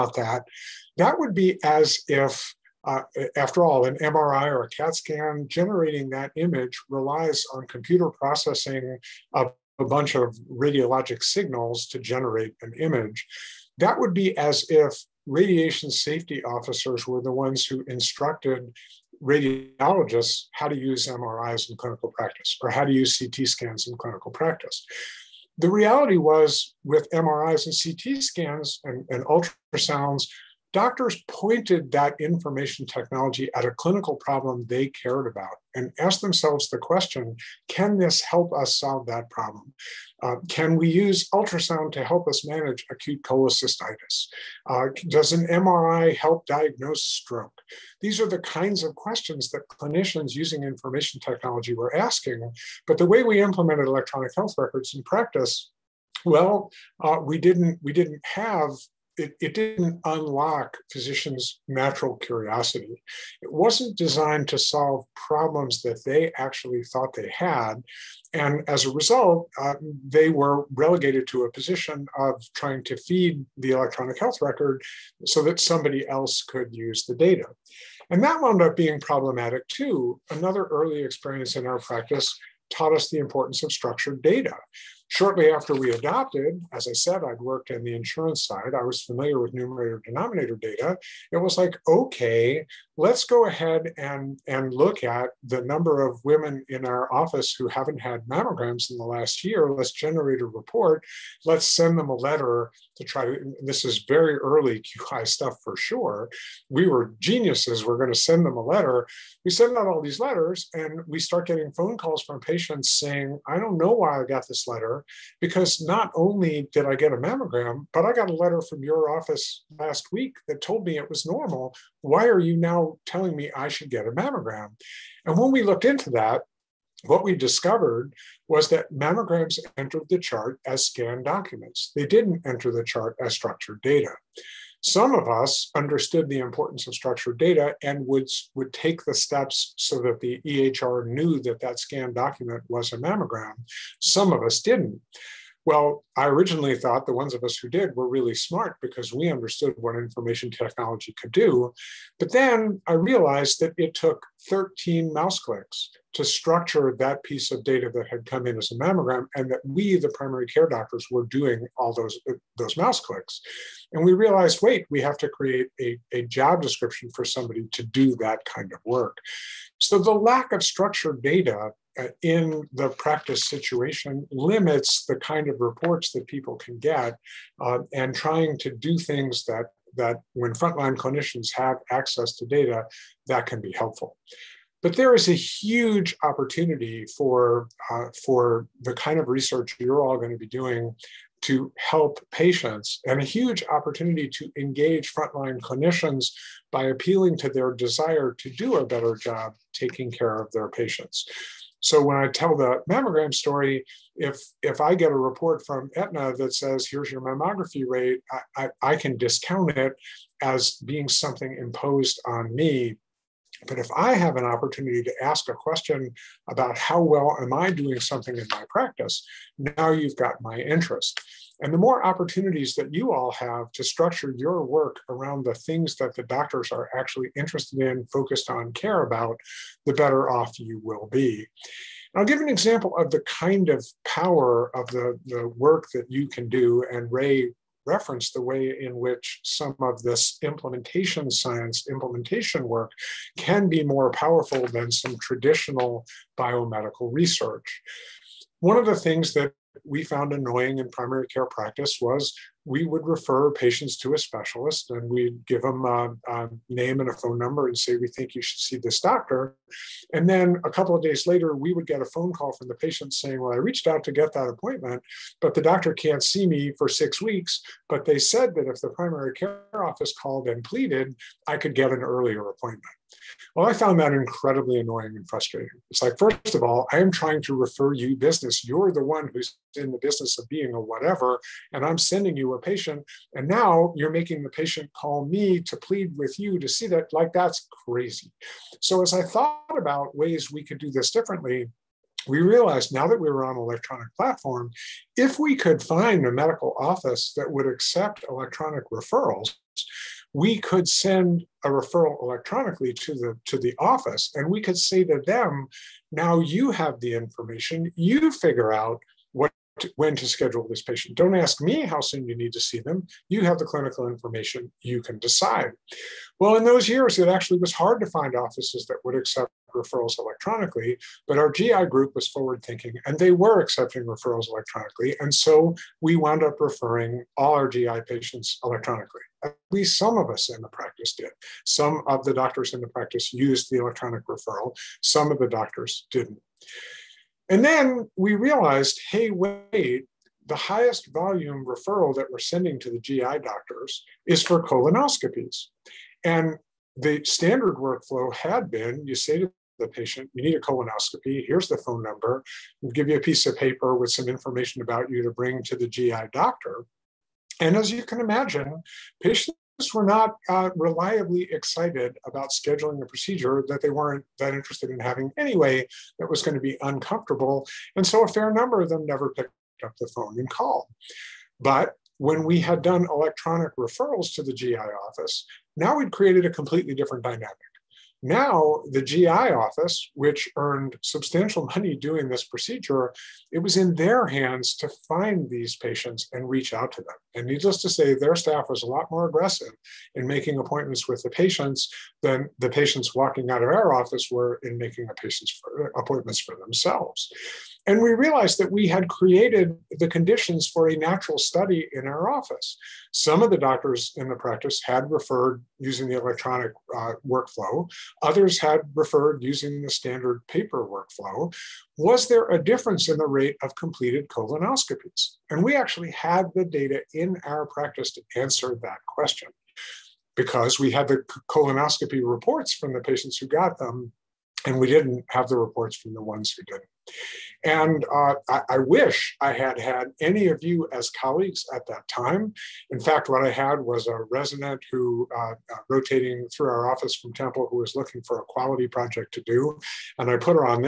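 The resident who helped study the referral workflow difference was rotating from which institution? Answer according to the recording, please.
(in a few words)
Temple.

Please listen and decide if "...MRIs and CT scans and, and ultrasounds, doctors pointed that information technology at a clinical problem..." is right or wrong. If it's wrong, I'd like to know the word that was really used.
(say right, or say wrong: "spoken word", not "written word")
right.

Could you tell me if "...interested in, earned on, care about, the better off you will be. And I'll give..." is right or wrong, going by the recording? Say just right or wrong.
wrong.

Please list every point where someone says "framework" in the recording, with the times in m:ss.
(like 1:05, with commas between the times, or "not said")
not said.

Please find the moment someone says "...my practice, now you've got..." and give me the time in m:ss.
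3:38.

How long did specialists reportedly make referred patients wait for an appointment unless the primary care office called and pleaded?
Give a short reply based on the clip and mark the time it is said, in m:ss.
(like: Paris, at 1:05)
6 weeks, at 4:26.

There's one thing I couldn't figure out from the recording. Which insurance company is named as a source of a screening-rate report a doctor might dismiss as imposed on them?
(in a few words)
Aetna.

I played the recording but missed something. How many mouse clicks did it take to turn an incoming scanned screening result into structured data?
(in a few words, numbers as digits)
13.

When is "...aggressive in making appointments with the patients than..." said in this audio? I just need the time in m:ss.
6:29.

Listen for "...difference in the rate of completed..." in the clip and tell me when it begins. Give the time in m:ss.
6:52.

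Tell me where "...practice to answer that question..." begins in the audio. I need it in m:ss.
6:57.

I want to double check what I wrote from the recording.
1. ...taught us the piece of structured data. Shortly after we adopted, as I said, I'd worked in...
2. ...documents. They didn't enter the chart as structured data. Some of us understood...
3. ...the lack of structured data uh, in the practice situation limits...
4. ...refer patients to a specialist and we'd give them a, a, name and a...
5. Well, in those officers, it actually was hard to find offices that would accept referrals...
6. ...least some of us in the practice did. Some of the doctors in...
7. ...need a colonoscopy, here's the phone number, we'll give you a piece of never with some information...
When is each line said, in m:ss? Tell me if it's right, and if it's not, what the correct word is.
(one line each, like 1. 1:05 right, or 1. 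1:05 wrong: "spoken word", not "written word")
1. 1:22 wrong: "importance", not "piece"
2. 2:11 right
3. 2:49 right
4. 4:13 right
5. 5:16 wrong: "years", not "officers"
6. 5:29 right
7. 5:50 wrong: "paper", not "never".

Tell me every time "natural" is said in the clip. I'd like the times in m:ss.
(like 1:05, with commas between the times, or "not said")
1:01, 6:40.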